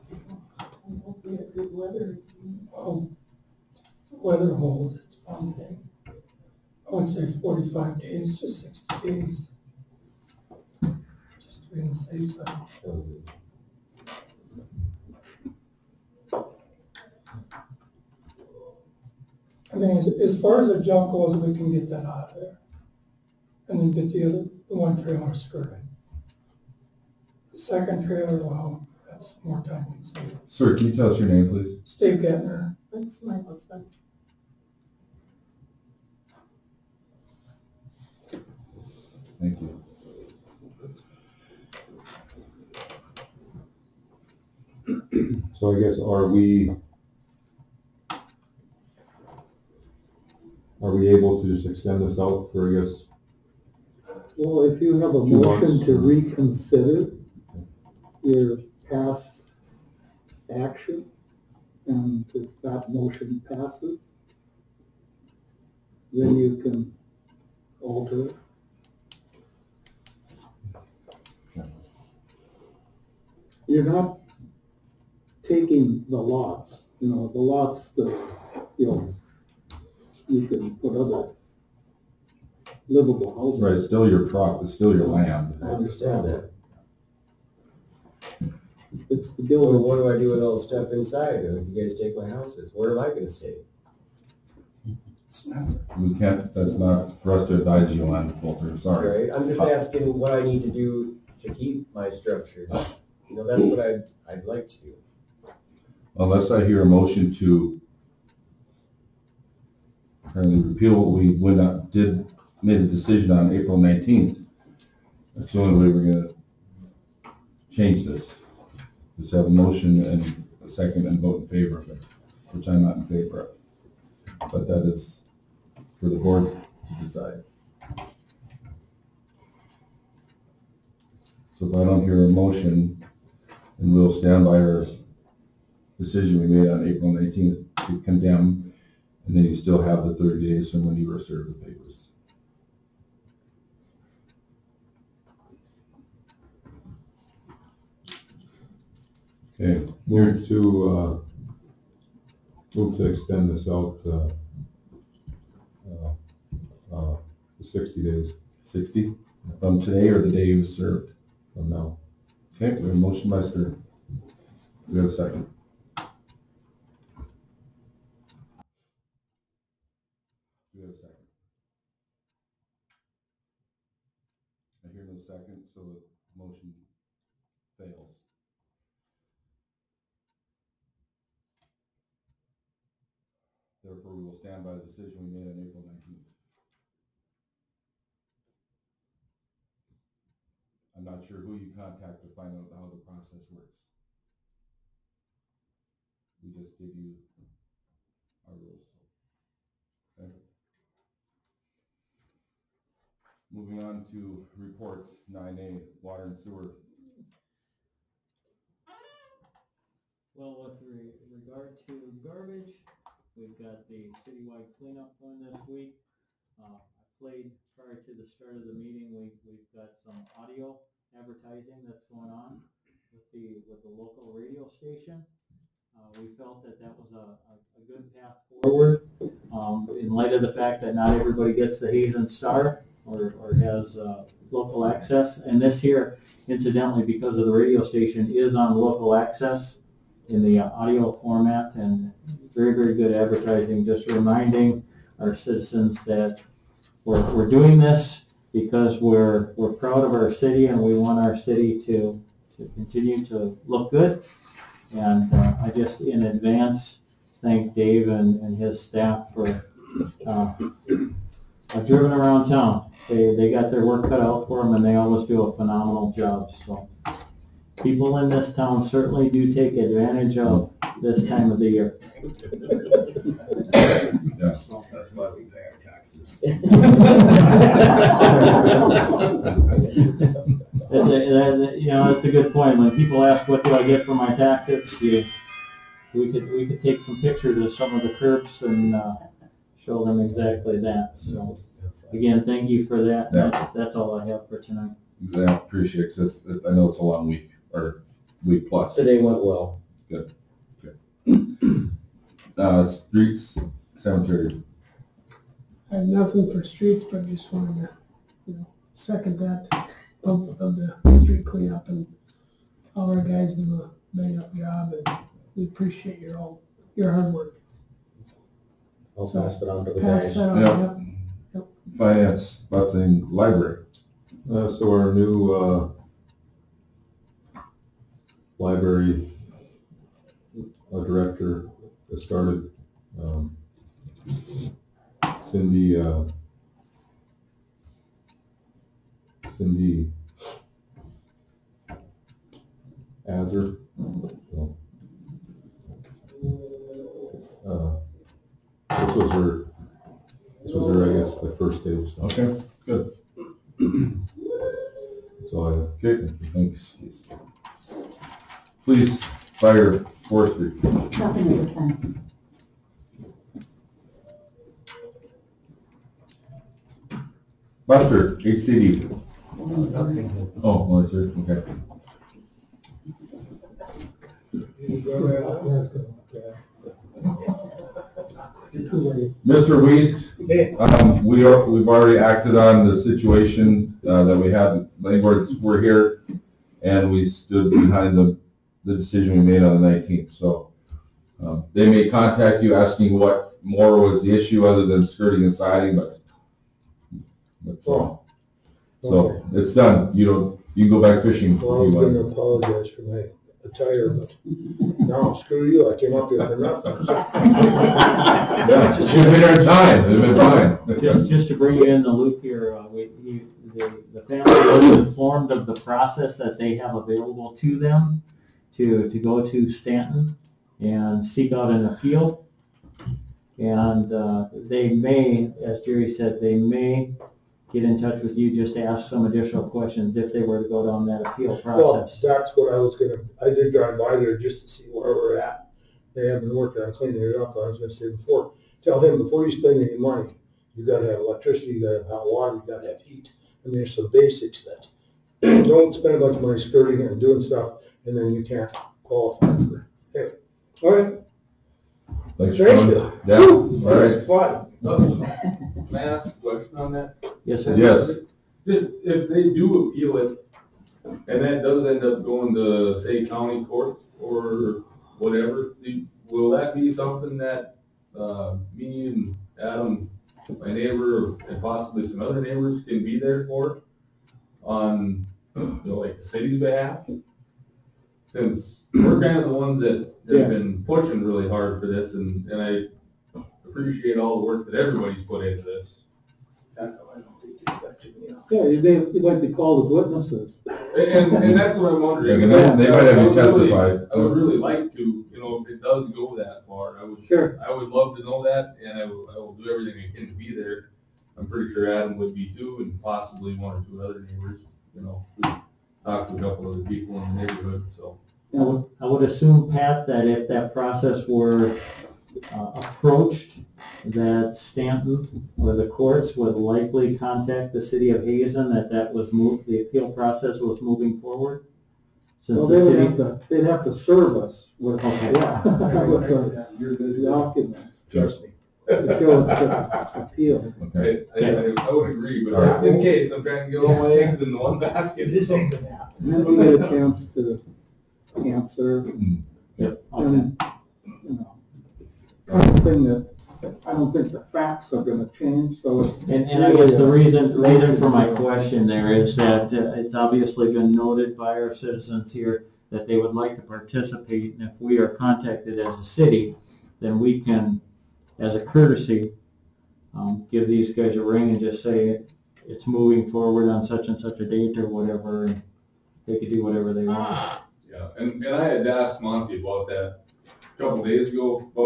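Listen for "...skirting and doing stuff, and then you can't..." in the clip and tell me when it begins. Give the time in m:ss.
7:26.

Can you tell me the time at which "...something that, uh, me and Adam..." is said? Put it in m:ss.
7:46.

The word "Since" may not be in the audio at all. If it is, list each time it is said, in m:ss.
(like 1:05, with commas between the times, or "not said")
7:58, 8:42.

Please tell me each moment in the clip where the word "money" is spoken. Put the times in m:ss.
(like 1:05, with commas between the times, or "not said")
7:19, 7:26.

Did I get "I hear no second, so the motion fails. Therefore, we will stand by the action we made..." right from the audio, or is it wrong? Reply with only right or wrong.
wrong.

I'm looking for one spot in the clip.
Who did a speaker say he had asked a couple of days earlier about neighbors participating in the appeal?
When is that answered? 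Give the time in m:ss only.
9:29.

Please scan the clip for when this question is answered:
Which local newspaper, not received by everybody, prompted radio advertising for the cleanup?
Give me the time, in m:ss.
3:51.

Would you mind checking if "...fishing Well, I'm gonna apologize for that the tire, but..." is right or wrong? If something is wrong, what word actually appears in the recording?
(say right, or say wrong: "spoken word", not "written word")
right.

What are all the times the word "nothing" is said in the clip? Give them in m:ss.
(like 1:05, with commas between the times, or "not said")
5:06, 6:00, 6:46.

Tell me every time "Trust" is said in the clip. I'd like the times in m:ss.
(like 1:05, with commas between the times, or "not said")
8:48.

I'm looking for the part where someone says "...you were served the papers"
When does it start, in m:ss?
2:20.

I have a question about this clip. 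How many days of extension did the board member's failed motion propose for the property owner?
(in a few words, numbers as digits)
60.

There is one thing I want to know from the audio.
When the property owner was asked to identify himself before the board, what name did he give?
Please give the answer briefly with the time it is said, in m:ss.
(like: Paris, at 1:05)
Steve Gettner, at 0:31.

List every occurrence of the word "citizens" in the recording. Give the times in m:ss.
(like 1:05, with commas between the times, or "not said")
4:05, 9:11.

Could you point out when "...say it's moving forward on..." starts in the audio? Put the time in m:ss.
9:21.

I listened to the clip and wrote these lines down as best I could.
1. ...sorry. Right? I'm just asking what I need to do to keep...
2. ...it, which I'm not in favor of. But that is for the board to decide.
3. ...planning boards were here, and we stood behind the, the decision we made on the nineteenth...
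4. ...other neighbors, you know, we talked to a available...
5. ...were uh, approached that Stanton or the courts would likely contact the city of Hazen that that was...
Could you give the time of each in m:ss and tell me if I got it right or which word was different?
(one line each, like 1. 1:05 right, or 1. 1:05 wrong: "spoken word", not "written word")
1. 1:38 right
2. 2:01 right
3. 6:25 right
4. 8:24 wrong: "couple", not "available"
5. 8:31 right.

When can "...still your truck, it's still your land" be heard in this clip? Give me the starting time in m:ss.
1:23.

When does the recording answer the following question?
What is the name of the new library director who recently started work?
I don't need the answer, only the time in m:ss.
5:39.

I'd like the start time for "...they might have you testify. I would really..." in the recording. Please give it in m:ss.
8:12.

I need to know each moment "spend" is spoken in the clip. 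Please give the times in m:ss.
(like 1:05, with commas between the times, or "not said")
7:19, 7:25.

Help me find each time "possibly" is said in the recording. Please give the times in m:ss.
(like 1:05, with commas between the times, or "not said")
7:51, 8:23.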